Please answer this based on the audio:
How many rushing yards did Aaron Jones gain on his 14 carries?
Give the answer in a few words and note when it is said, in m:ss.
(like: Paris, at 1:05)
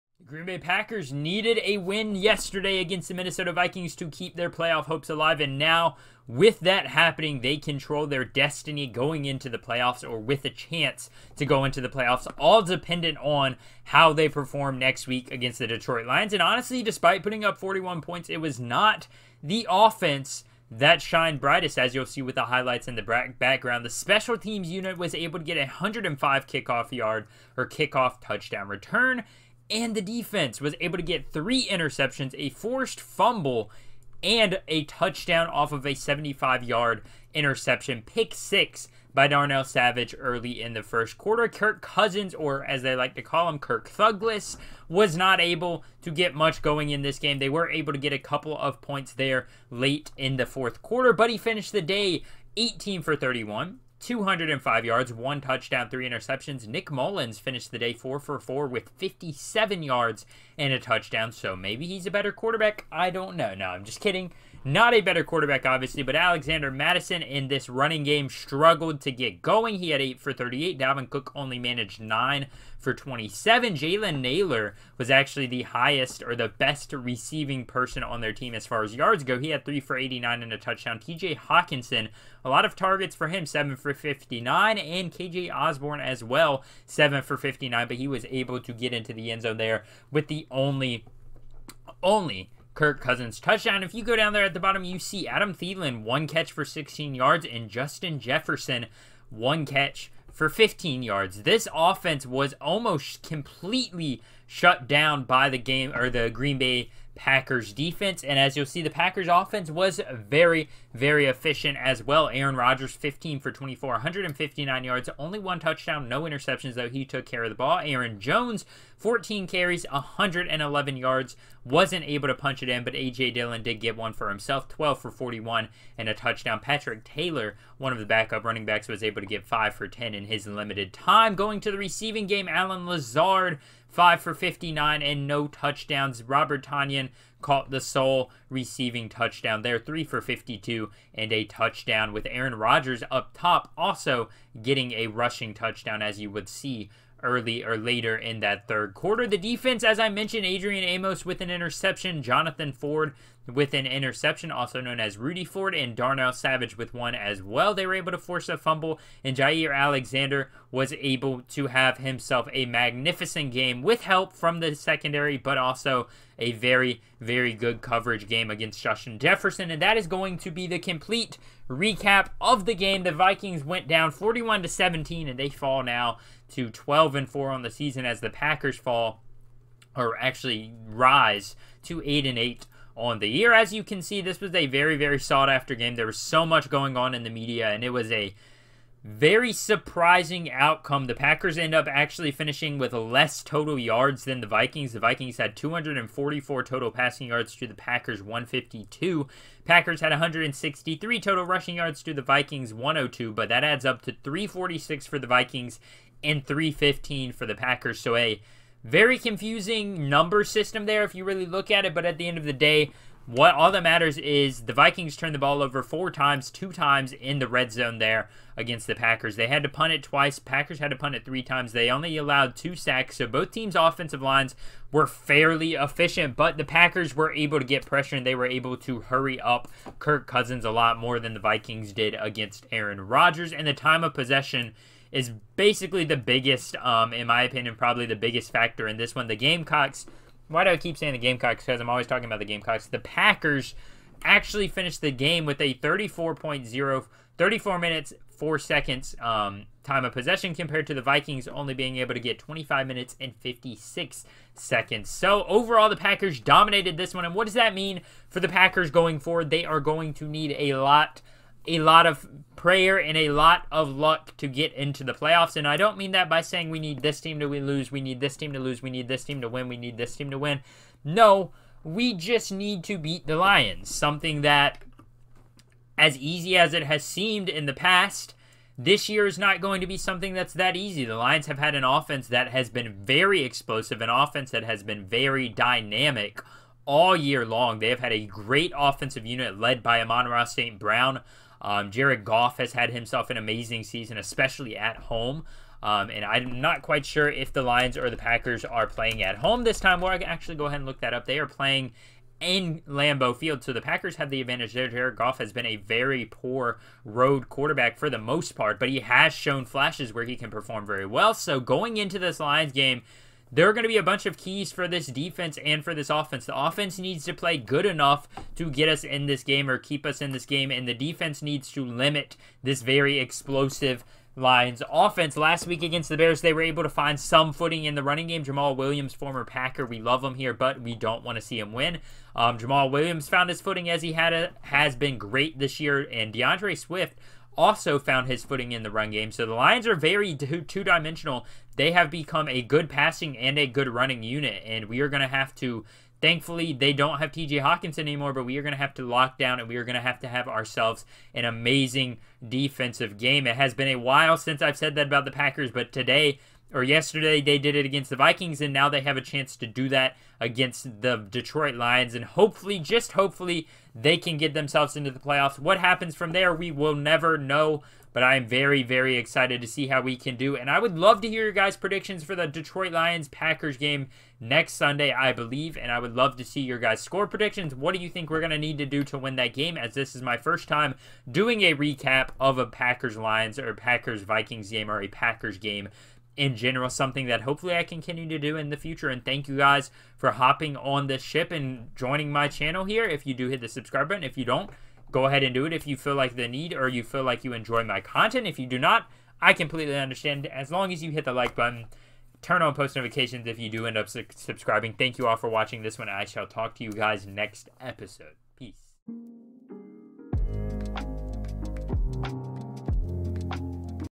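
111, at 1:59.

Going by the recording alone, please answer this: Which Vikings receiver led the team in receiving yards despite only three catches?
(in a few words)
Jalen Nailor.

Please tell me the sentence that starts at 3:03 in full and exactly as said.
As you can see, this was a very, very sought after game.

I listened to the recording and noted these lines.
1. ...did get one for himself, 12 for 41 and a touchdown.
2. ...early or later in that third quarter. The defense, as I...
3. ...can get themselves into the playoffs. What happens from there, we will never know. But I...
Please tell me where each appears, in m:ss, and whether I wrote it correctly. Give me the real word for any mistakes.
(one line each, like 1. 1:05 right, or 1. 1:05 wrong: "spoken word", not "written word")
1. 2:03 right
2. 2:27 right
3. 6:04 right.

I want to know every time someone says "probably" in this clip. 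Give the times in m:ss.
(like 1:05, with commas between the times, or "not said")
3:57.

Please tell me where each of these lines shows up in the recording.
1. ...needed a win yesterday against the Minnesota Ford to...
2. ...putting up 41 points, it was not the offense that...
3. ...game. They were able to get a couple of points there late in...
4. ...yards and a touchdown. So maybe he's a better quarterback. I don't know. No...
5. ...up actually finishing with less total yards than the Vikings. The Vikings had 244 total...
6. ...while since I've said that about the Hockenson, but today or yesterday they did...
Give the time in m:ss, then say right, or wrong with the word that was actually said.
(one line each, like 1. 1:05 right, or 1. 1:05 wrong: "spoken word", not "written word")
1. 0:01 wrong: "Vikings", not "Ford"
2. 0:17 right
3. 0:47 right
4. 0:59 right
5. 3:11 right
6. 5:53 wrong: "Packers", not "Hockenson".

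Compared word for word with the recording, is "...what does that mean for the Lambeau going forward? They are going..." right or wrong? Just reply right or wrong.
wrong.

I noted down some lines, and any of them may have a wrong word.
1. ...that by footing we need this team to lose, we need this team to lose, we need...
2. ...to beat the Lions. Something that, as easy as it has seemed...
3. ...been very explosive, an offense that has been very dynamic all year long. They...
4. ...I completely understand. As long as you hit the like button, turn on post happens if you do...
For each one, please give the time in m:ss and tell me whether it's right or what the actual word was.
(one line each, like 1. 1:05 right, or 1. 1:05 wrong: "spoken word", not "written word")
1. 4:26 wrong: "saying", not "footing"
2. 4:32 right
3. 4:42 right
4. 6:39 wrong: "notifications", not "happens".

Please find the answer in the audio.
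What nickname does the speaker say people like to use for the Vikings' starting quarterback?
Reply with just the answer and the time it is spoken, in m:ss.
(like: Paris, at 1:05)
Kirk Thugless, at 0:43.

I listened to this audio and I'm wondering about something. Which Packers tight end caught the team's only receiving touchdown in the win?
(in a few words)
Robert Tonyan.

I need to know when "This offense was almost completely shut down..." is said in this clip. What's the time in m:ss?
1:41.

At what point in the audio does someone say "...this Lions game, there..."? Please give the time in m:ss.
5:12.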